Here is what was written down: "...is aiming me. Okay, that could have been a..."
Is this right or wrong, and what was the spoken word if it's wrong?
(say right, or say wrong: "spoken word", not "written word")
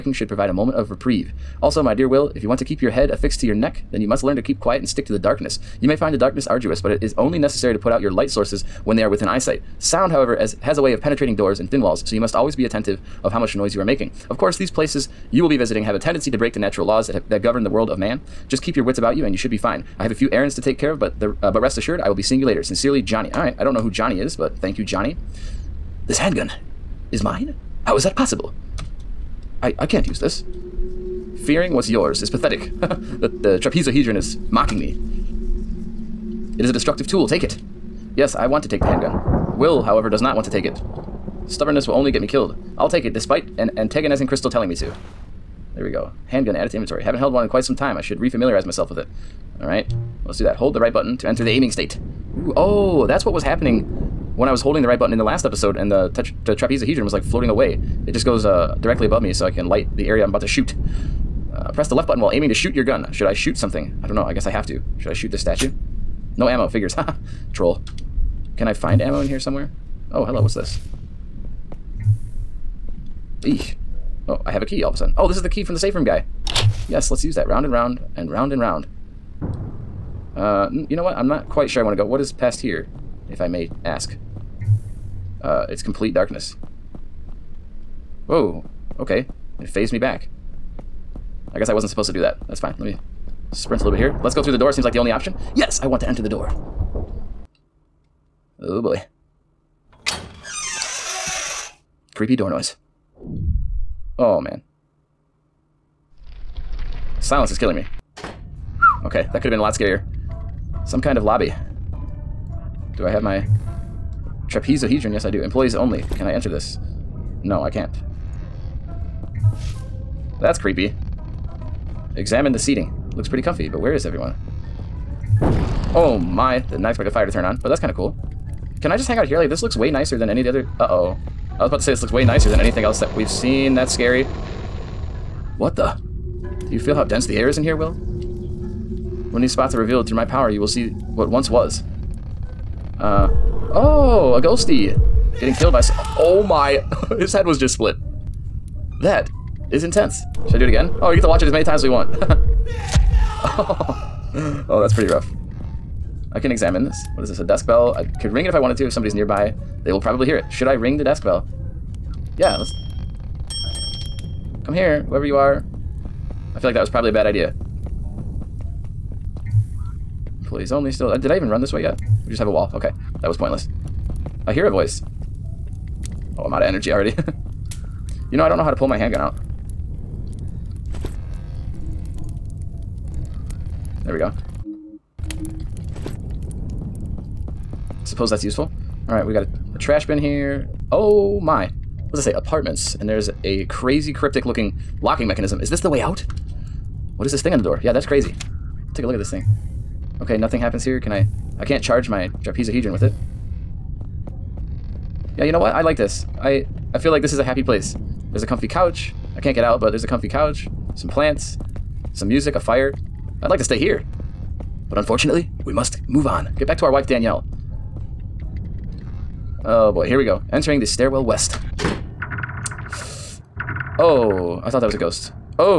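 wrong: "killing", not "aiming".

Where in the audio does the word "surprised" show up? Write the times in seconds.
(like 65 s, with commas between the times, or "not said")
not said.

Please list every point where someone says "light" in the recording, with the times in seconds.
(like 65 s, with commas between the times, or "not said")
8 s, 59 s.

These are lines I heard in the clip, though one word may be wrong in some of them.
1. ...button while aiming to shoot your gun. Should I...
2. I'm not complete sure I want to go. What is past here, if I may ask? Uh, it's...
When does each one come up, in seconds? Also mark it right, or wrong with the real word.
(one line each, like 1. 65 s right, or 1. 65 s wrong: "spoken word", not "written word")
1. 62 s right
2. 81 s wrong: "quite", not "complete".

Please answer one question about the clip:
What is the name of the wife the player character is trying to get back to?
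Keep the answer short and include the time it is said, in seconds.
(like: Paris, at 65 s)
Danielle, at 217 s.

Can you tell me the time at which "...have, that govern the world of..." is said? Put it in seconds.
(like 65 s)
17 s.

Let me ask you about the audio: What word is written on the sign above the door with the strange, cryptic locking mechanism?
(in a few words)
Apartments.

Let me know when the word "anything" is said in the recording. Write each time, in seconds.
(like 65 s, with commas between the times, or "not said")
132 s.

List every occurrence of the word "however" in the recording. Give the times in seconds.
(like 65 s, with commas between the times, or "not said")
10 s, 39 s.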